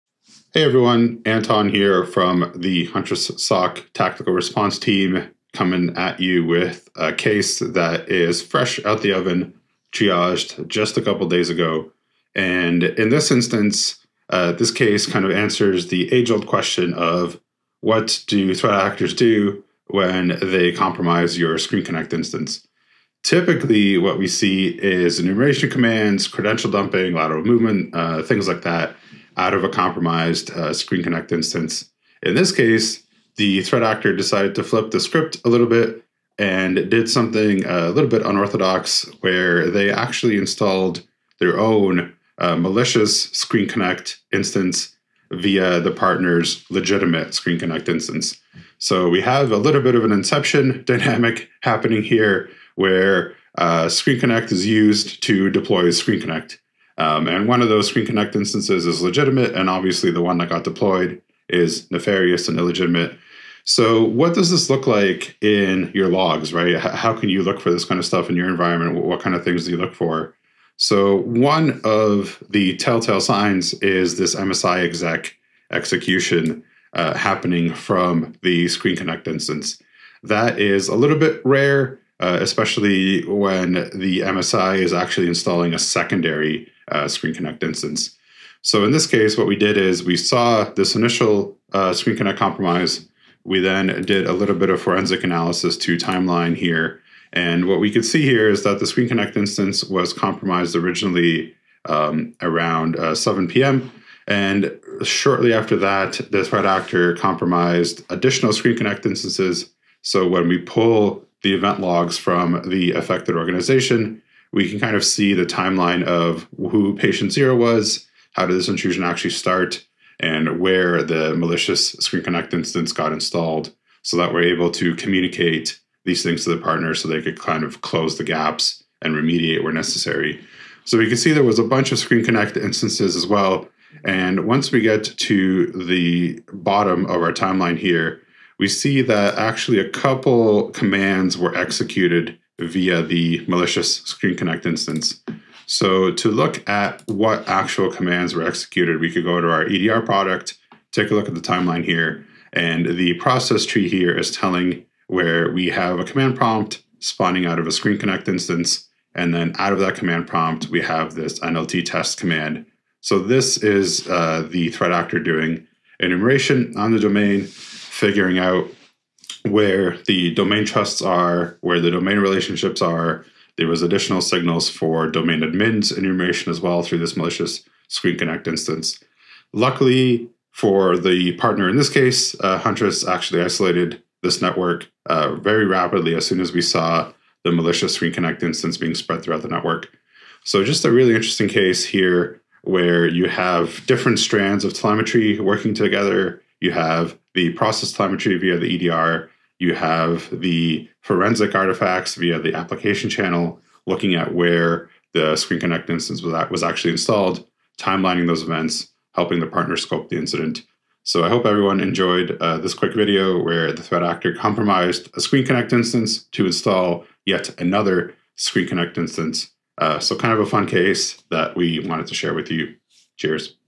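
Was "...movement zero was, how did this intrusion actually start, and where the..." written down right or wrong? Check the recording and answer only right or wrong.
wrong.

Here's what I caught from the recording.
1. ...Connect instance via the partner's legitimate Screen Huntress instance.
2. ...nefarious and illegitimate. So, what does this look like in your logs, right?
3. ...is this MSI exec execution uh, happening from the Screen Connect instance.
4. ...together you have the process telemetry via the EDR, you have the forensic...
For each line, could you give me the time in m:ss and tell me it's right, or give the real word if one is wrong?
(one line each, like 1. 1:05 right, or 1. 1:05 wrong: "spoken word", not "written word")
1. 0:43 wrong: "Connect", not "Huntress"
2. 1:01 right
3. 1:13 right
4. 3:15 right.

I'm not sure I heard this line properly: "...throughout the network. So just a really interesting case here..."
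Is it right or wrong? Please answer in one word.
right.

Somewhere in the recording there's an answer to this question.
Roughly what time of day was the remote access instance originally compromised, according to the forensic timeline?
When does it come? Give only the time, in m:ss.
1:43.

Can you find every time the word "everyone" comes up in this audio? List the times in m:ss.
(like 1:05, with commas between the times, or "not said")
0:00, 3:31.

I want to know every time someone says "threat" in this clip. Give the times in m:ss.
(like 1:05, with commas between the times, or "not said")
0:18, 0:33, 1:46, 2:44, 3:33.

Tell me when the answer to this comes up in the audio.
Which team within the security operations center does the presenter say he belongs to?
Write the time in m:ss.
0:03.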